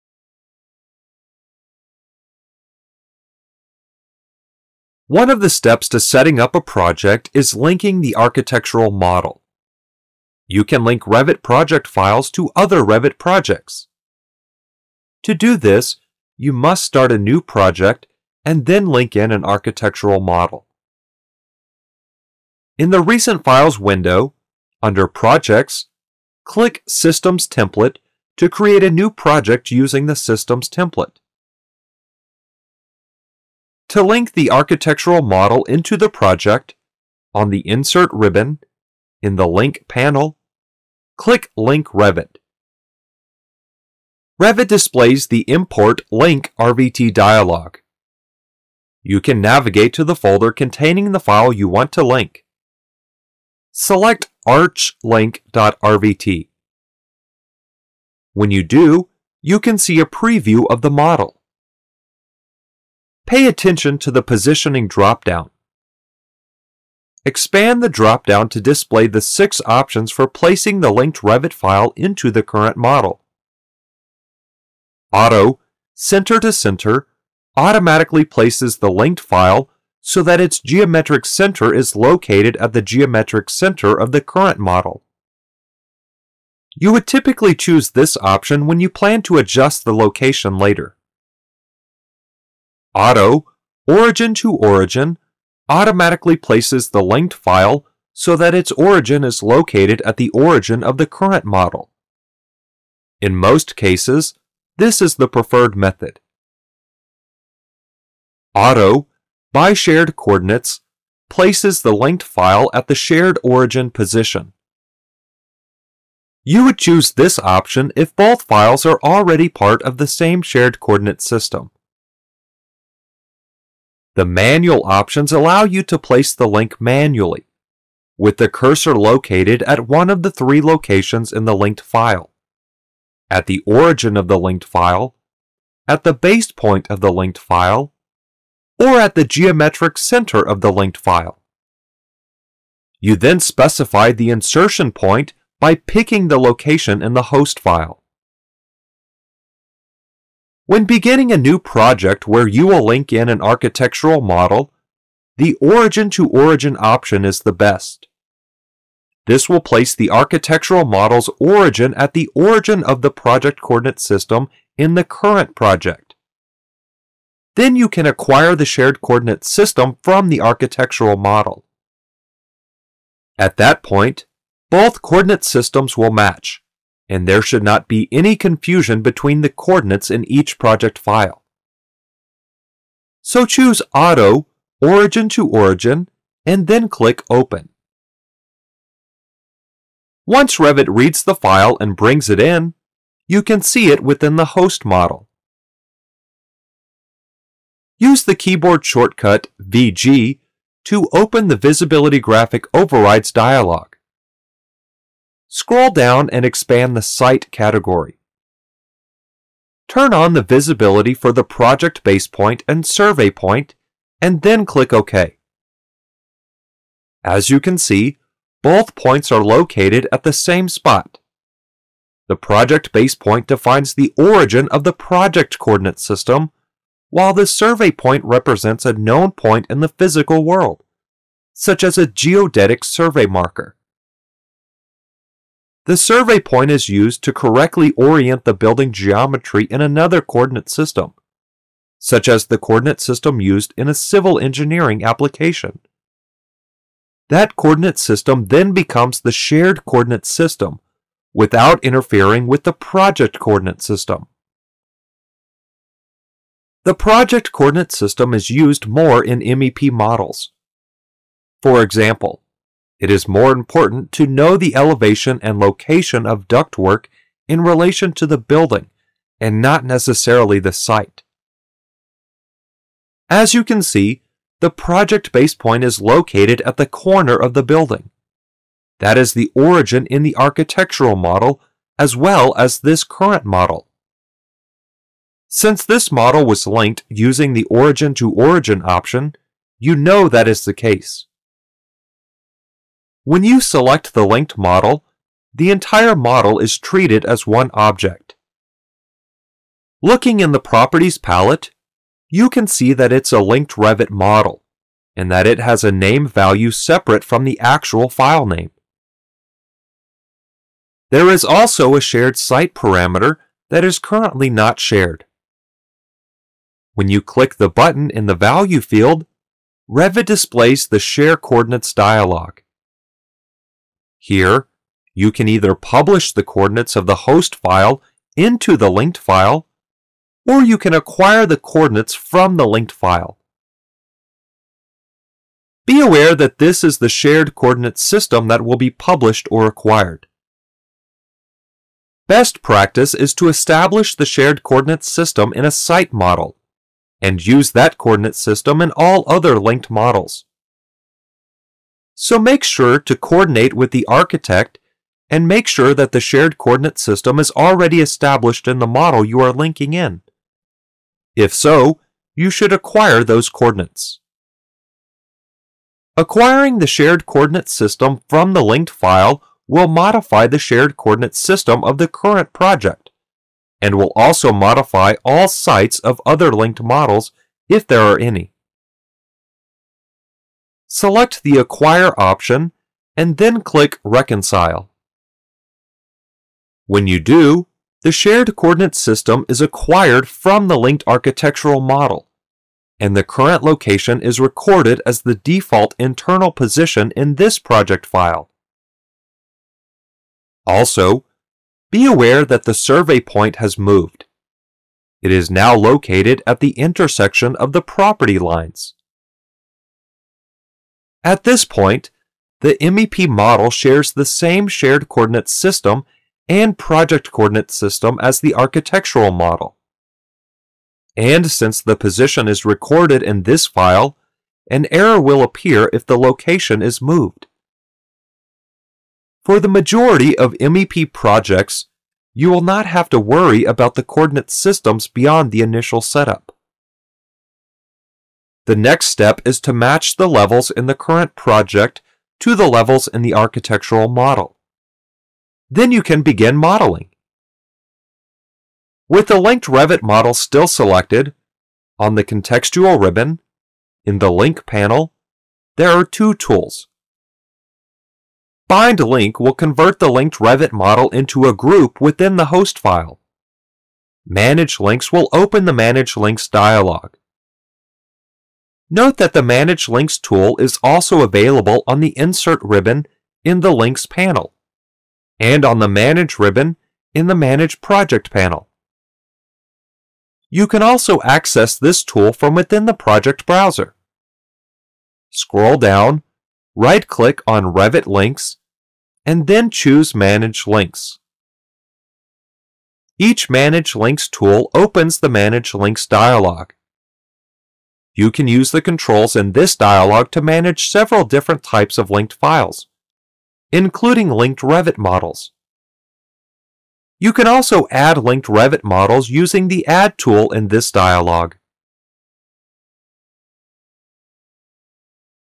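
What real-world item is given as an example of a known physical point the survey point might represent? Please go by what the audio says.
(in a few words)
geodetic survey marker.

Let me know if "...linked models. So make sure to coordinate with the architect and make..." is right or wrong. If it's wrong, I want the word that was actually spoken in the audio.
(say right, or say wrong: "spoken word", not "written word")
right.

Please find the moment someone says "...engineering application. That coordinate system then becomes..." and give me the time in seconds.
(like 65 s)
244 s.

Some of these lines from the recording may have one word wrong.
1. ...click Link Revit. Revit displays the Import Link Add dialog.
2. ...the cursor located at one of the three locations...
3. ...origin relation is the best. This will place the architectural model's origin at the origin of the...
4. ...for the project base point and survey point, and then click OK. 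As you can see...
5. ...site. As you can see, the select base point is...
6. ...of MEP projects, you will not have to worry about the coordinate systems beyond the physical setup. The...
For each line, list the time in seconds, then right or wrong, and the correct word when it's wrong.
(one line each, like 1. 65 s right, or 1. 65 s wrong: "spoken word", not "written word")
1. 41 s wrong: "RVT", not "Add"
2. 128 s right
3. 156 s wrong: "option", not "relation"
4. 211 s right
5. 270 s wrong: "project", not "select"
6. 430 s wrong: "initial", not "physical".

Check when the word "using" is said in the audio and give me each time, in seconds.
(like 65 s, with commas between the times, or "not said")
29 s, 287 s, 509 s.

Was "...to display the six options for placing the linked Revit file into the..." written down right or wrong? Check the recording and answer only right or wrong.
right.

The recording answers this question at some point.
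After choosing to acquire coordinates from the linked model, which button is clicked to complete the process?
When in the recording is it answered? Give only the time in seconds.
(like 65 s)
384 s.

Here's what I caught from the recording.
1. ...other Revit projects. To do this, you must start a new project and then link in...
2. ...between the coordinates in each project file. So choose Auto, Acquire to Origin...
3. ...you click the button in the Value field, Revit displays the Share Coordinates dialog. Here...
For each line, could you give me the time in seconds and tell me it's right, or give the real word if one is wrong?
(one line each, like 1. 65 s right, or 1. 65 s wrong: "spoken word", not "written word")
1. 12 s right
2. 179 s wrong: "Origin", not "Acquire"
3. 317 s right.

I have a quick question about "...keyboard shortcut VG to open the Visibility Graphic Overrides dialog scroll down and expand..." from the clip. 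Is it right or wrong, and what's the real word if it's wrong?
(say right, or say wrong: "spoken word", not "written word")
right.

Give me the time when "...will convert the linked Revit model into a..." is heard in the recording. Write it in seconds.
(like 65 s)
459 s.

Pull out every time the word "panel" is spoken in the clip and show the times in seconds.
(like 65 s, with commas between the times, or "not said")
39 s, 454 s, 474 s, 478 s.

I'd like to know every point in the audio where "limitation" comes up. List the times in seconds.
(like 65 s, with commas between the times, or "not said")
not said.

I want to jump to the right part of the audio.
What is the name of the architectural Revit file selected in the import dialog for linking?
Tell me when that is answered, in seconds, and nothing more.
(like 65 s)
54 s.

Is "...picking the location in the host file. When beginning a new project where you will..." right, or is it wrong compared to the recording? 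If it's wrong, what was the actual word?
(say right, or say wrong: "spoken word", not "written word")
right.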